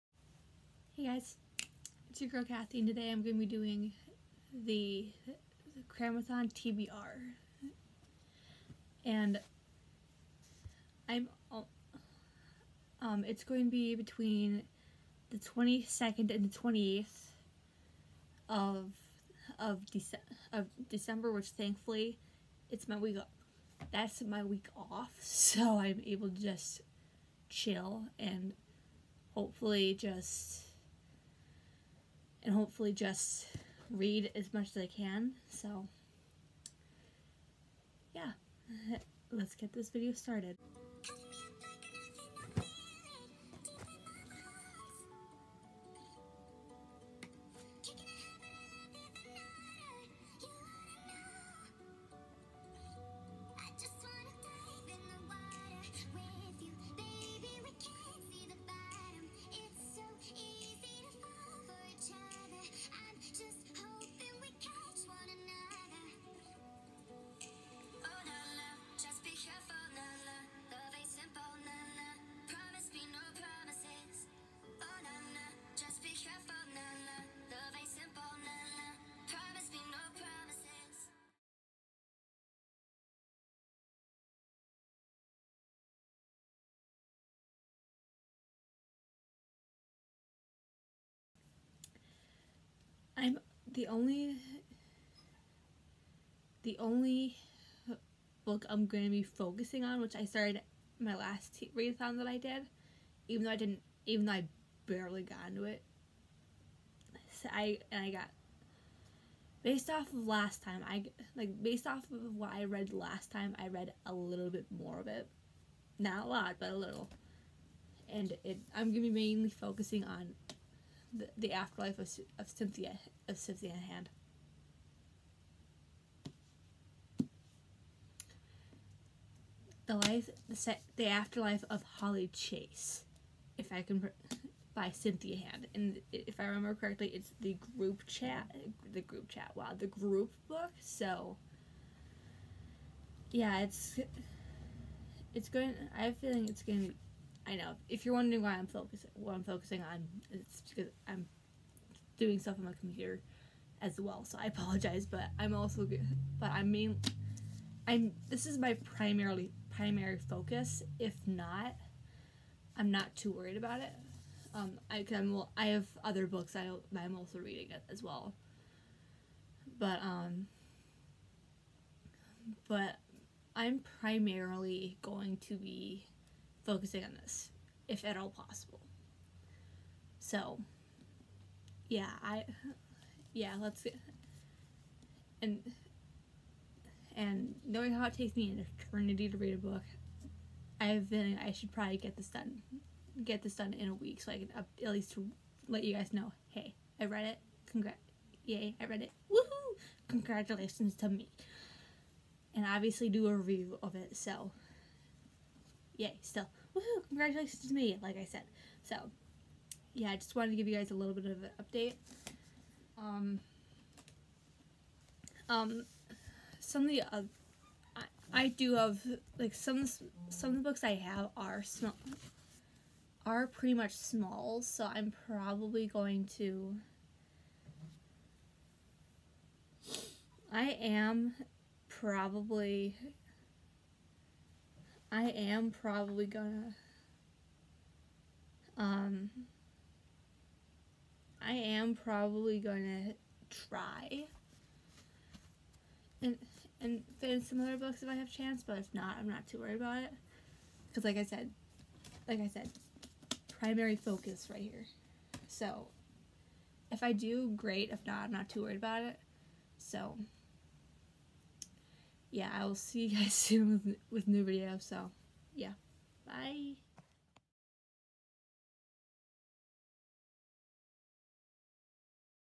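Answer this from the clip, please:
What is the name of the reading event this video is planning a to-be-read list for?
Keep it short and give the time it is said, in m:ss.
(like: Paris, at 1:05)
Cramathon, at 0:05.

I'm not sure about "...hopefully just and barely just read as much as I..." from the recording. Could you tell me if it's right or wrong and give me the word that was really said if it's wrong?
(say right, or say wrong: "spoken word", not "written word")
wrong: "hopefully", not "barely".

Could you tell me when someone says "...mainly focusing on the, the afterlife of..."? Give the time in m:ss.
1:59.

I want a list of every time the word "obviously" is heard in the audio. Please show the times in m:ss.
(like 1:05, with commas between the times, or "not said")
3:22.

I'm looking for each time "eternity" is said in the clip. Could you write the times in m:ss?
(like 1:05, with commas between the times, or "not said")
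3:08.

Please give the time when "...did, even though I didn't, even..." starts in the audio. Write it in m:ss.
1:42.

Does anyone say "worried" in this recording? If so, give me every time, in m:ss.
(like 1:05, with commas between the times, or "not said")
2:43, 4:09, 4:18.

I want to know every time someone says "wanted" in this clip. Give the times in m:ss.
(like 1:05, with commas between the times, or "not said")
3:30.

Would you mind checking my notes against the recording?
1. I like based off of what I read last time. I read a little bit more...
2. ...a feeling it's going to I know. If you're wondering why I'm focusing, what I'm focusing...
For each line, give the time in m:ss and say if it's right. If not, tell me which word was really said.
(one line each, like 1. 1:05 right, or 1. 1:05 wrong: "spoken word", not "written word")
1. 1:50 right
2. 2:26 right.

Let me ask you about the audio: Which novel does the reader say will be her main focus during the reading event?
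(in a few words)
The Afterlife of Holly Chase.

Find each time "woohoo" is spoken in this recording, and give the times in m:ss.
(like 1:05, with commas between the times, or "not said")
3:19, 3:26.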